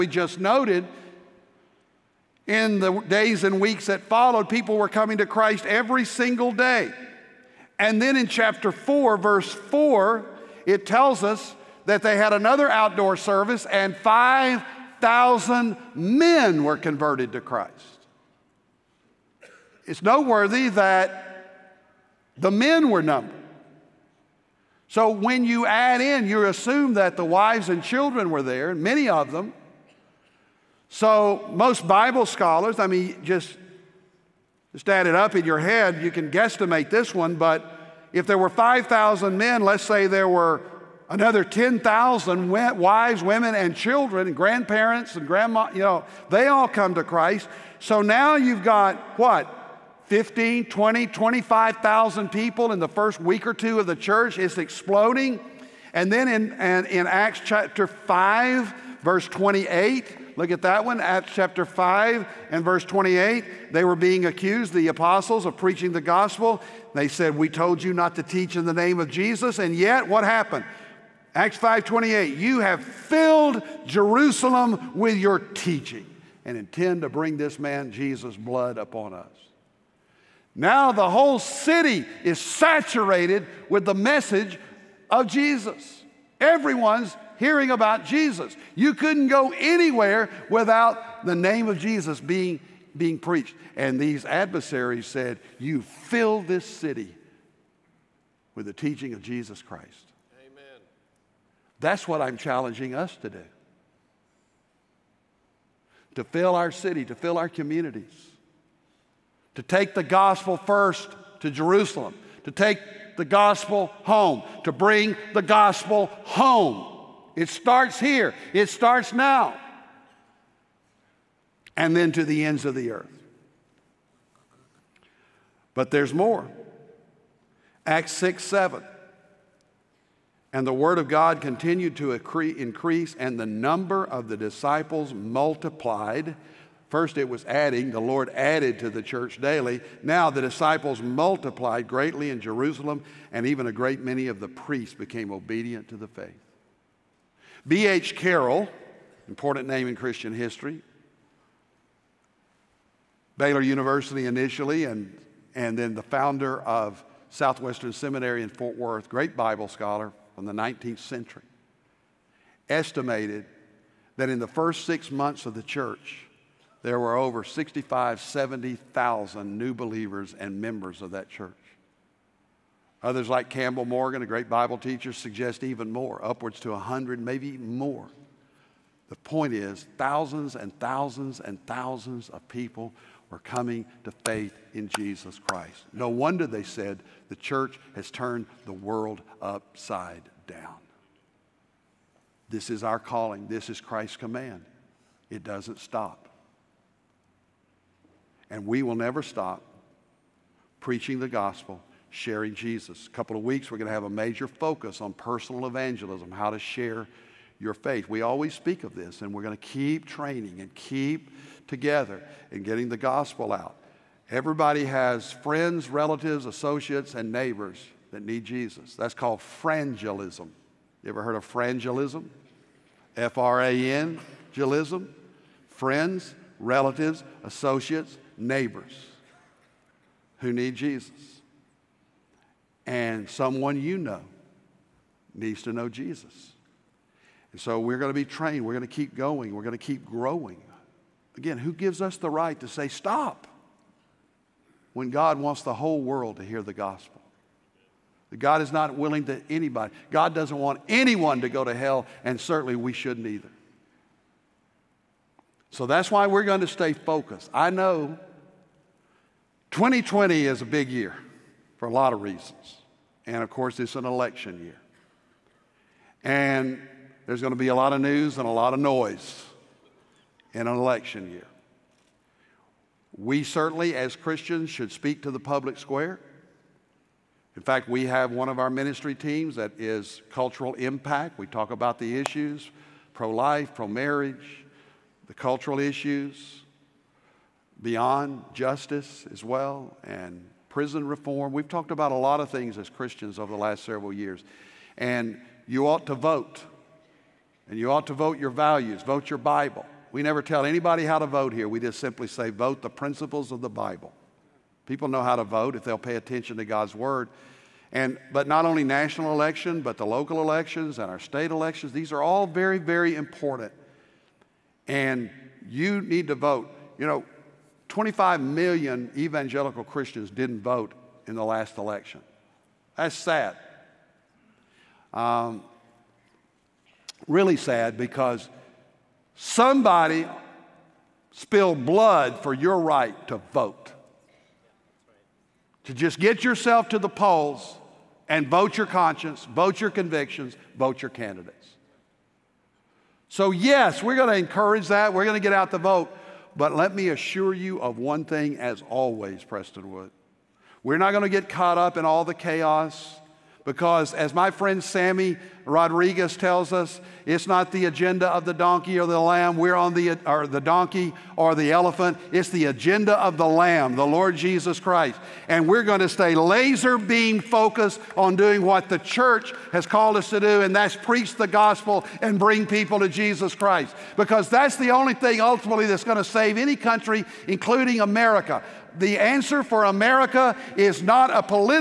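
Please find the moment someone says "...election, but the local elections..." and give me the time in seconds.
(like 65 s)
309 s.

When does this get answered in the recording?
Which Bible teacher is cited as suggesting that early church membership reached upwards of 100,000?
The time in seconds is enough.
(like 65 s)
173 s.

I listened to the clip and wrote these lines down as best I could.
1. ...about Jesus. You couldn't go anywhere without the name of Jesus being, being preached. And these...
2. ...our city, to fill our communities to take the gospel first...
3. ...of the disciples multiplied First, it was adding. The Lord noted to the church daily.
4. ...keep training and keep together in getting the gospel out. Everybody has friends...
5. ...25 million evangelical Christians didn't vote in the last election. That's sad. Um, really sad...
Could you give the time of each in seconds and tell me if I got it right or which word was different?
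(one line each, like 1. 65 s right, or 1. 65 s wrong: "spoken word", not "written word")
1. 87 s right
2. 106 s right
3. 134 s wrong: "added", not "noted"
4. 209 s right
5. 317 s right.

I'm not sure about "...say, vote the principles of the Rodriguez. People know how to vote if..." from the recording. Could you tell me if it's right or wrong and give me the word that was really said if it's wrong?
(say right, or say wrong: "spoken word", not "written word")
wrong: "Bible", not "Rodriguez".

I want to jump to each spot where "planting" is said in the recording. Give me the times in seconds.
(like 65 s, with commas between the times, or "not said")
not said.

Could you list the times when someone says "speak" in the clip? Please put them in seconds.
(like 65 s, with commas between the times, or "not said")
208 s, 274 s.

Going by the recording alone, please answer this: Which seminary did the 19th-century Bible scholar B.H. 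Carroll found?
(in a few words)
Southwestern Seminary.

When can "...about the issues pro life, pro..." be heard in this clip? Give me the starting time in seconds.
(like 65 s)
281 s.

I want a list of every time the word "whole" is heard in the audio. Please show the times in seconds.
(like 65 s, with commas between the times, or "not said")
81 s, 245 s.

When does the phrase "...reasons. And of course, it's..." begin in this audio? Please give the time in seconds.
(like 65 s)
262 s.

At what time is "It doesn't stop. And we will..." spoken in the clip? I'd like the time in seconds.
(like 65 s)
195 s.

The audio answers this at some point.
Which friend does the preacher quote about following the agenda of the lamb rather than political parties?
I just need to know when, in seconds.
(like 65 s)
354 s.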